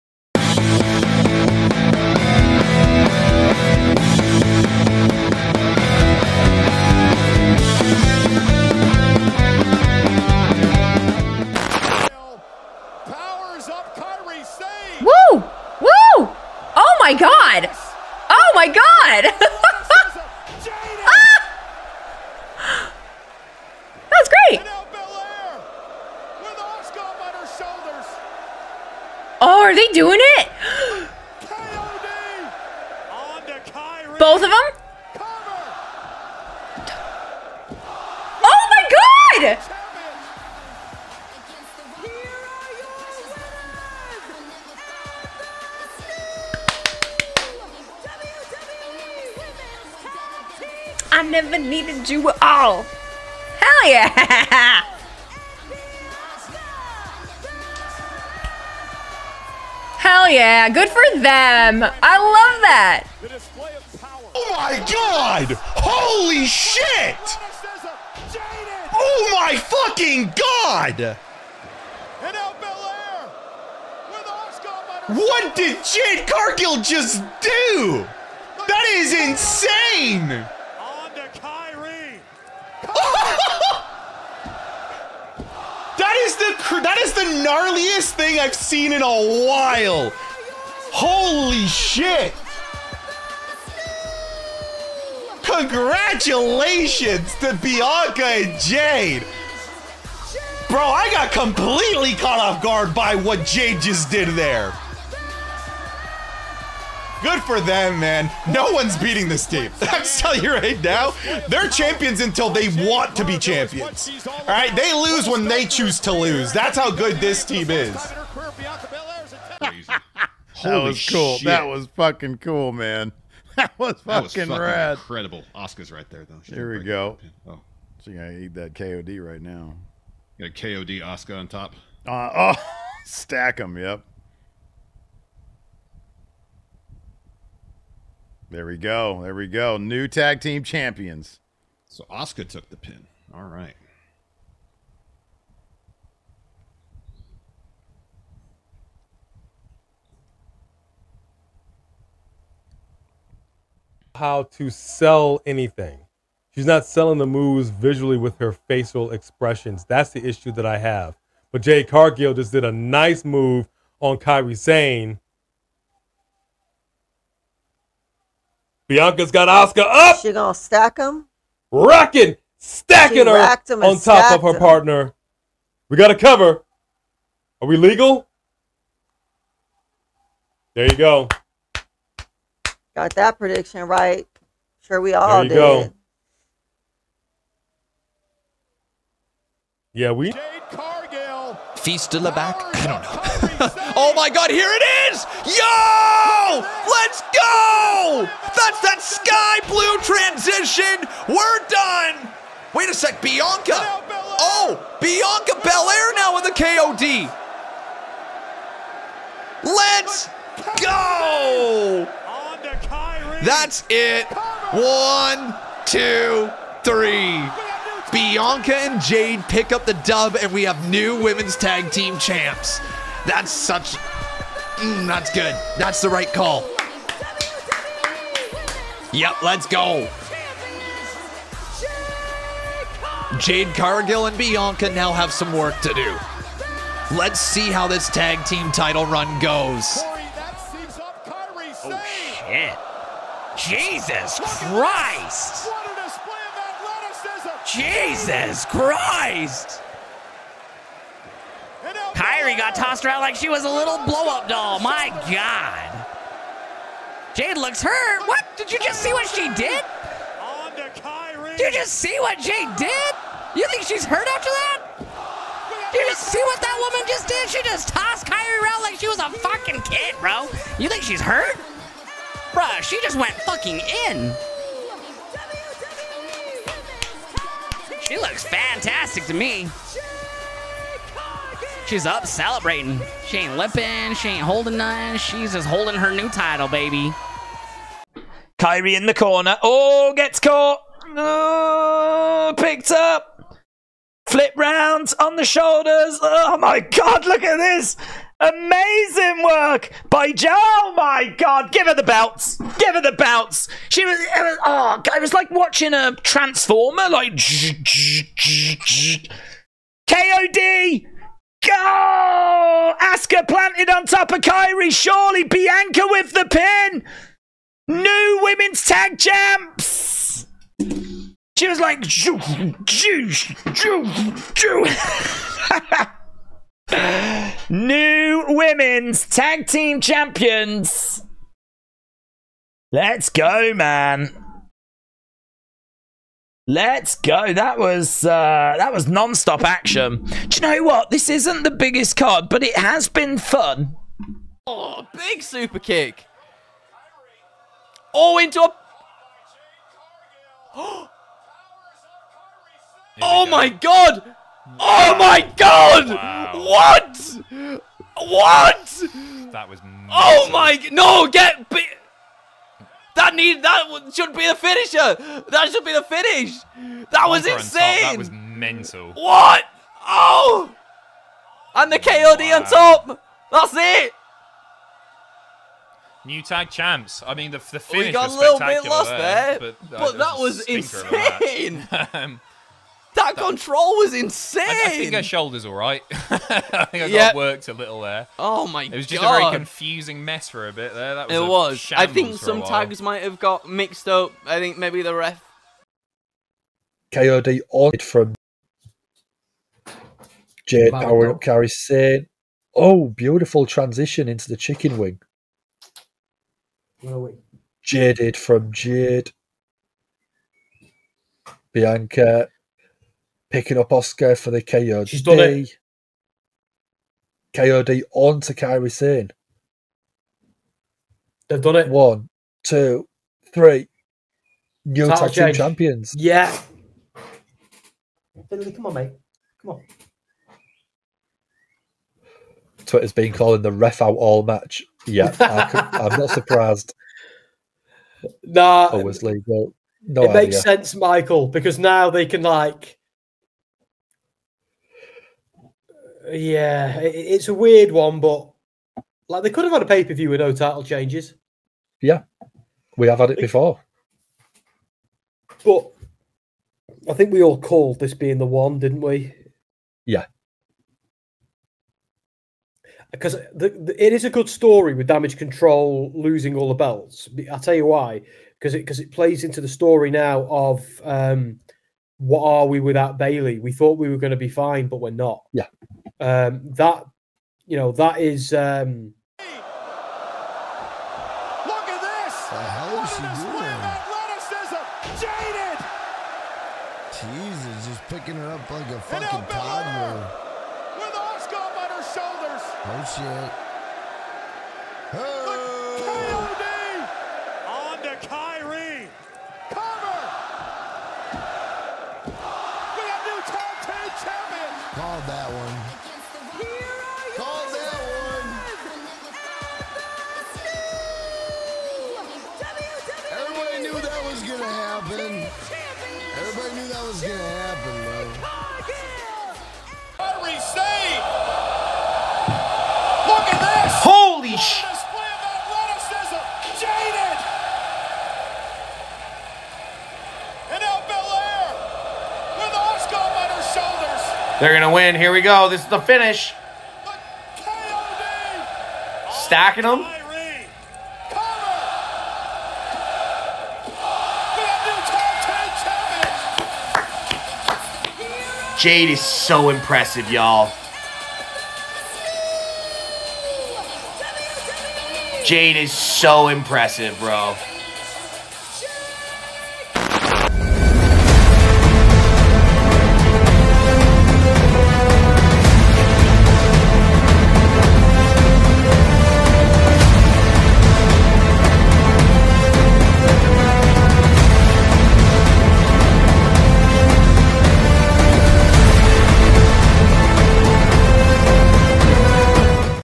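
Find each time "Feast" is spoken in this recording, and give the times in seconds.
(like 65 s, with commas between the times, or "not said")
191 s.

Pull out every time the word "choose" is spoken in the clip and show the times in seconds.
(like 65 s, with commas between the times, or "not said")
115 s.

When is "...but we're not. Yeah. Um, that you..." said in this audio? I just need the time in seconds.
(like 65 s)
474 s.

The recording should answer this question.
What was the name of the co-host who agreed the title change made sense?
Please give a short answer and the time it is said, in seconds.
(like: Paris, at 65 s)
Michael, at 440 s.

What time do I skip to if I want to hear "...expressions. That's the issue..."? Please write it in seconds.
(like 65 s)
159 s.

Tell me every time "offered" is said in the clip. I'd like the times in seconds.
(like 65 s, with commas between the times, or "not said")
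not said.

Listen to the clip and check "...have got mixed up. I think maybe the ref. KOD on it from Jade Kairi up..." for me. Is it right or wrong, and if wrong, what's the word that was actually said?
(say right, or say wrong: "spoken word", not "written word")
wrong: "Power", not "Kairi".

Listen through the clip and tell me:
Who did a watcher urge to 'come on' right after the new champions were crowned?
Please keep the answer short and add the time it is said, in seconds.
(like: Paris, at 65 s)
Finley, at 428 s.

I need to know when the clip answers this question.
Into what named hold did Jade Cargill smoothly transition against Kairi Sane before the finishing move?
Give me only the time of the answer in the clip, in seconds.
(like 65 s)
404 s.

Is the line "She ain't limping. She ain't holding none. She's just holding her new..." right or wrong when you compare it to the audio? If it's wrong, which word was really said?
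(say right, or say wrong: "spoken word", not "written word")
right.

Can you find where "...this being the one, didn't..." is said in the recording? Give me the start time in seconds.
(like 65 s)
457 s.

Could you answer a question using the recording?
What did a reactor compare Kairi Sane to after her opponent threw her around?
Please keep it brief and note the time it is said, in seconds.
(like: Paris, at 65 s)
Blow-up doll, at 254 s.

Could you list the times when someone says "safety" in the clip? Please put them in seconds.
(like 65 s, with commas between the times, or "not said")
not said.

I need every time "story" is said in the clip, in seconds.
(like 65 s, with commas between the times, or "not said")
464 s, 469 s.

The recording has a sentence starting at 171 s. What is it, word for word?
Rocking, stacking she her on top of her him.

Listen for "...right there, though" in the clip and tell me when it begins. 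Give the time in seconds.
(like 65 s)
125 s.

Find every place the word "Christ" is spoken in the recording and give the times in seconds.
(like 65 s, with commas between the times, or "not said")
244 s, 248 s.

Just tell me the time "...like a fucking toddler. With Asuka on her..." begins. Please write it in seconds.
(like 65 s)
488 s.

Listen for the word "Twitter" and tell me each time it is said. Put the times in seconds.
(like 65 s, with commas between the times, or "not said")
432 s.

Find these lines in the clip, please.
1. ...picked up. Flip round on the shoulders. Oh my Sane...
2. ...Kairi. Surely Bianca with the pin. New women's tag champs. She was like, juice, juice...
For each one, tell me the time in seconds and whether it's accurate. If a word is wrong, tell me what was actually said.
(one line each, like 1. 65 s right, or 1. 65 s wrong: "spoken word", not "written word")
1. 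292 s wrong: "God", not "Sane"
2. 314 s right.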